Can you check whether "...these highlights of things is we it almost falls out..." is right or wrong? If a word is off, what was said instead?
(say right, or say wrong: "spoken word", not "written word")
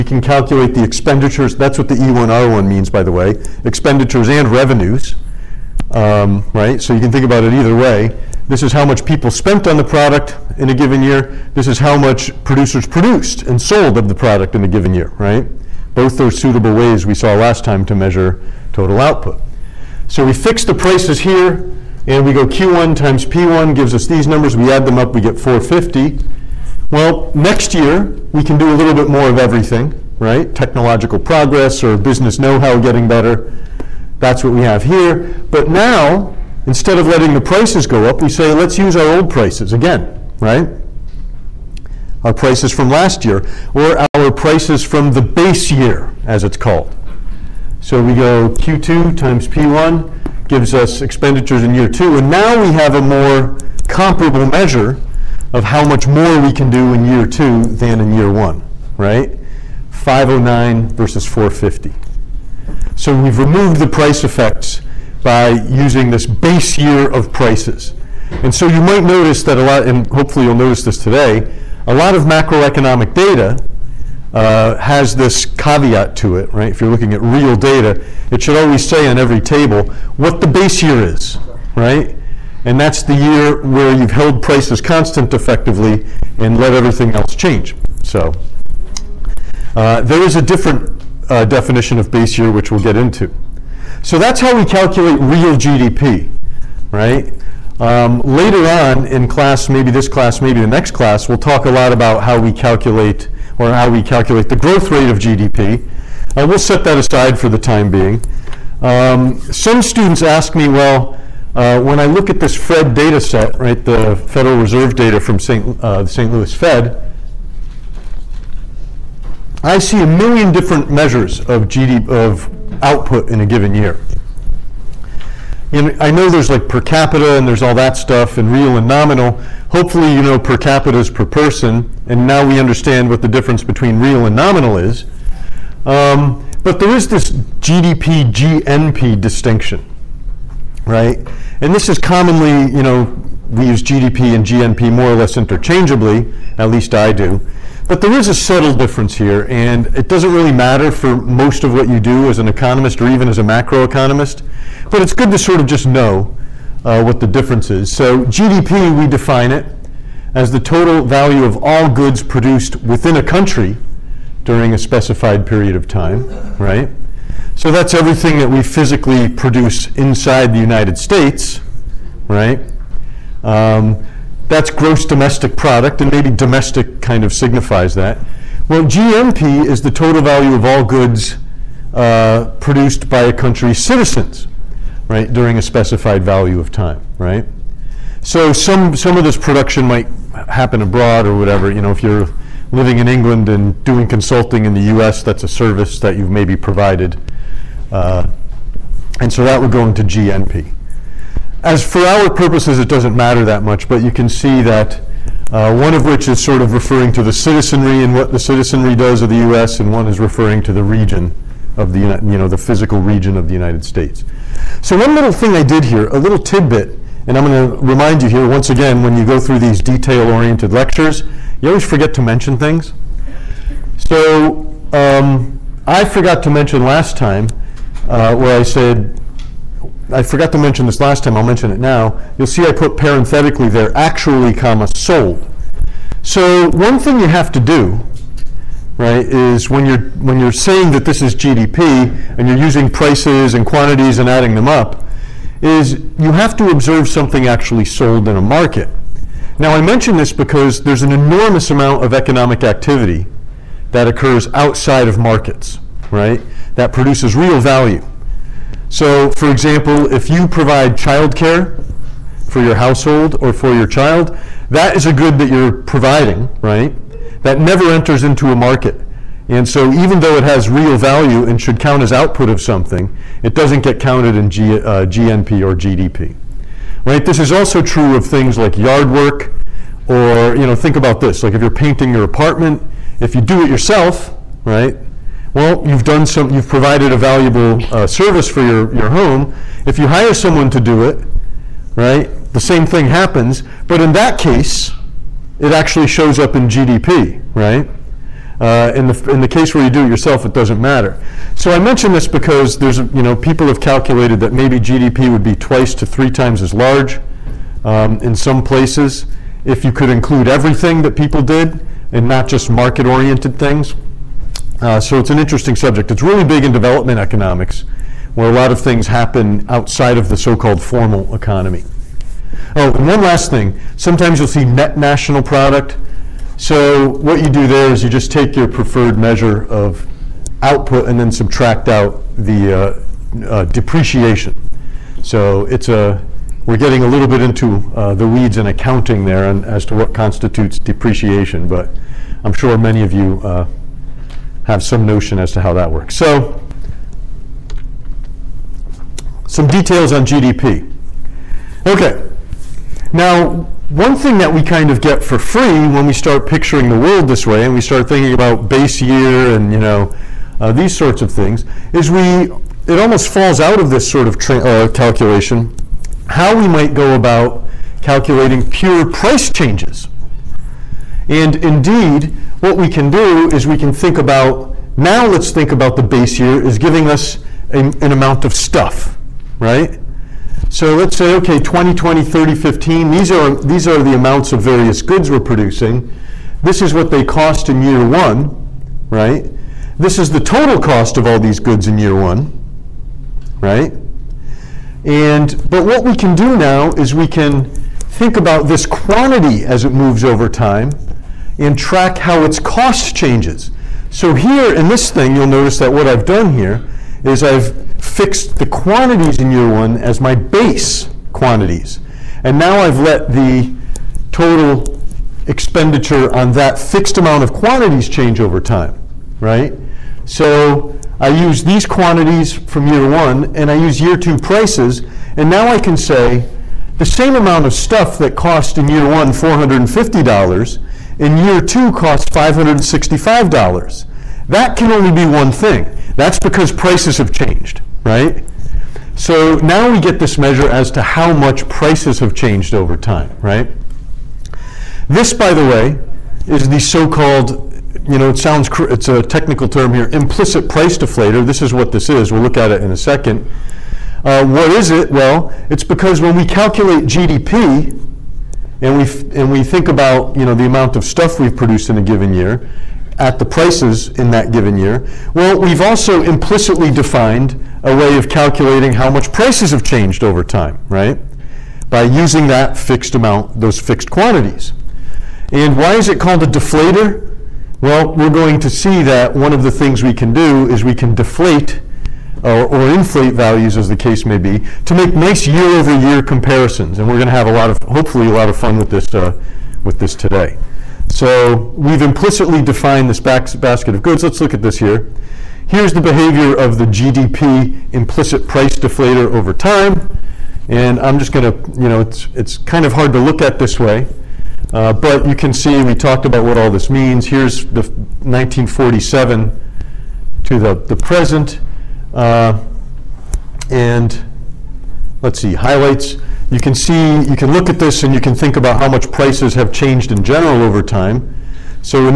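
wrong: "sorts", not "highlights".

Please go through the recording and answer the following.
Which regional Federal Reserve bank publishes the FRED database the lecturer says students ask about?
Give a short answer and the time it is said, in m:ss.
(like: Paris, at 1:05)
St. Louis Fed, at 1:56.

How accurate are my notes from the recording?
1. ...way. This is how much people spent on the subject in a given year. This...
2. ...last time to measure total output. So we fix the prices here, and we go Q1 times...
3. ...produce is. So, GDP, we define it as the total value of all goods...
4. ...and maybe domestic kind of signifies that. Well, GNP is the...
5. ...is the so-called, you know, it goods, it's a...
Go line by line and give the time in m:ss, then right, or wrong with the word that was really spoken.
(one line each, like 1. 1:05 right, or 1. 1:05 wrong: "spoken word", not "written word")
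1. 0:07 wrong: "product", not "subject"
2. 0:17 right
3. 2:37 wrong: "difference", not "produce"
4. 2:56 right
5. 7:26 wrong: "sounds", not "goods".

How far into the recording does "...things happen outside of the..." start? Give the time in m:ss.
5:18.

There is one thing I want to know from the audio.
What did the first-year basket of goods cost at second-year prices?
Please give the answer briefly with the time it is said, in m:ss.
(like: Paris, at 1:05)
$565, at 7:12.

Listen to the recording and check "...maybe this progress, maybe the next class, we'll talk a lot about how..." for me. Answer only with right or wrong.
wrong.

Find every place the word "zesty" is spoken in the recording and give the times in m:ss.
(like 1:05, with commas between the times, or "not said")
not said.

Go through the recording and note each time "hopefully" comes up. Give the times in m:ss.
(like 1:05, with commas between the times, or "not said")
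1:10, 2:09, 8:07.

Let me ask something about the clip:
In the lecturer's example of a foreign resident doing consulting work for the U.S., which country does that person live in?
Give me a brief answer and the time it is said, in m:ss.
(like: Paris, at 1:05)
England, at 3:13.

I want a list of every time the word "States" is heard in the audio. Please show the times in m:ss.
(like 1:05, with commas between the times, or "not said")
2:50, 3:33.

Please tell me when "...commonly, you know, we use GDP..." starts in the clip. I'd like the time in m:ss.
2:21.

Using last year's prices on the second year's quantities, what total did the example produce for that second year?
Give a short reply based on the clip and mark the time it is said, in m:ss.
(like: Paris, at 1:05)
509, at 0:59.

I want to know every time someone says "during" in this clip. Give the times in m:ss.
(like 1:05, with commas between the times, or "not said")
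2:44, 3:05.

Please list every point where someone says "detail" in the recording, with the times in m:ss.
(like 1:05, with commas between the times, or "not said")
3:39, 5:49.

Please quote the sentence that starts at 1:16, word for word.
If you're looking at real data, it should always say on every table what the base year is, right?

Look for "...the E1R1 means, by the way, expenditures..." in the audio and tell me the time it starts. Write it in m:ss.
0:01.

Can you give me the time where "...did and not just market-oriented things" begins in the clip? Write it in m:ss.
5:11.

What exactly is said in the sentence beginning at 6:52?
And now I've let the total expenditure on that fixed amount of quantities change over time, right?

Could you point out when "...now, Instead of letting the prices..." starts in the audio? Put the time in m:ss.
0:35.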